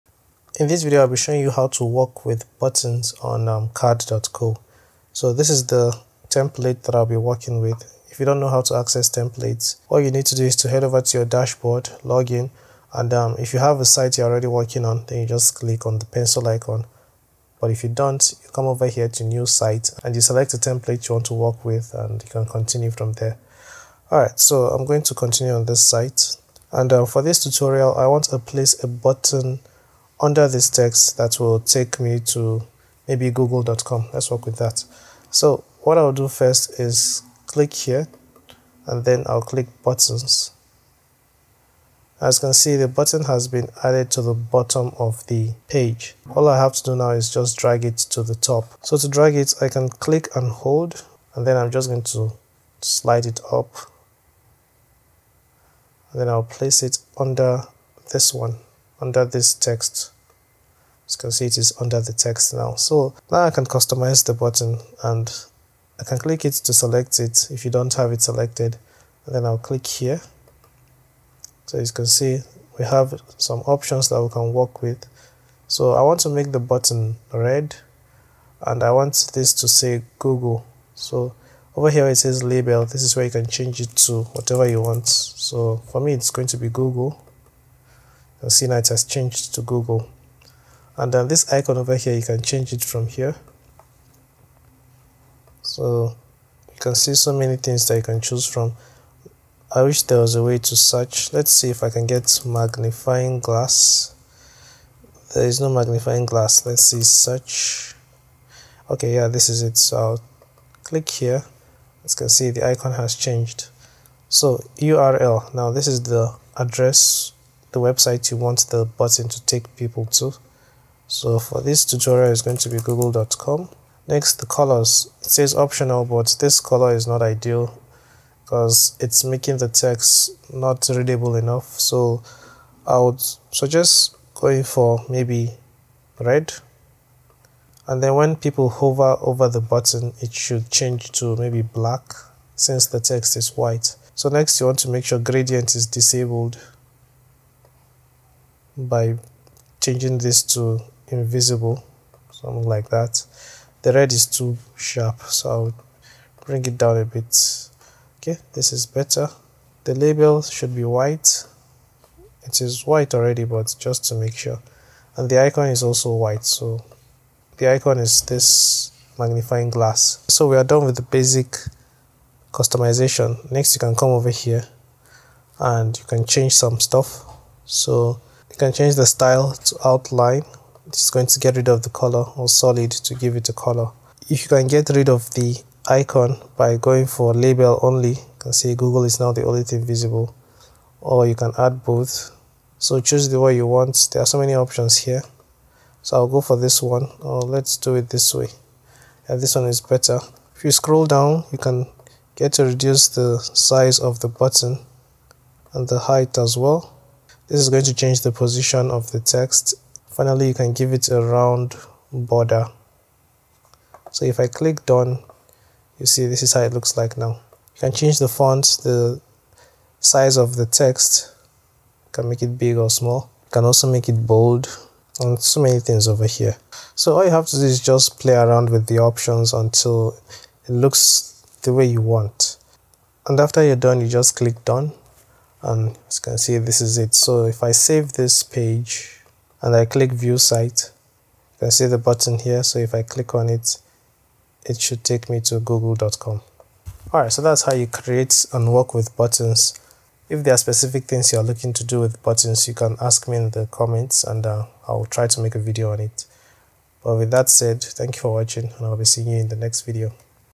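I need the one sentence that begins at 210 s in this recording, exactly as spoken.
Finally, you can give it a round border.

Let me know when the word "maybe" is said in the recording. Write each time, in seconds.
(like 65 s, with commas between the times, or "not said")
33 s, 135 s, 141 s.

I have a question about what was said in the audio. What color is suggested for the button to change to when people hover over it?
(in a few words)
black.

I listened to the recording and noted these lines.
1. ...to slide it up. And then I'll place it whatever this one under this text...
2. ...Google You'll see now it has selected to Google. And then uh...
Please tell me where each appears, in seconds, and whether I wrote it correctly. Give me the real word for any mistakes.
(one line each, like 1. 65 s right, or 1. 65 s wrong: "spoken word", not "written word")
1. 52 s wrong: "under", not "whatever"
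2. 86 s wrong: "changed", not "selected".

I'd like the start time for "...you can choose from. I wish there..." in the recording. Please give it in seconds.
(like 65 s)
97 s.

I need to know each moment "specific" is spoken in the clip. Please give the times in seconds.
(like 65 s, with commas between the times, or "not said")
250 s.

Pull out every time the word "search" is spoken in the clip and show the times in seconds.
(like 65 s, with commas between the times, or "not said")
100 s, 107 s.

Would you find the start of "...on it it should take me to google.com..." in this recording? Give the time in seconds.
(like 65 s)
243 s.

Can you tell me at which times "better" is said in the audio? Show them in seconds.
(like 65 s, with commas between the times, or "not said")
158 s, 199 s.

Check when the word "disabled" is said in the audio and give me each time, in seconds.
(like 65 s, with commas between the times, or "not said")
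145 s.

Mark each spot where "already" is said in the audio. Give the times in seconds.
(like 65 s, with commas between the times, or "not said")
14 s, 163 s.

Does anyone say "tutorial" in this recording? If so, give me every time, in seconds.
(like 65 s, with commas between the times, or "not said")
27 s, 121 s.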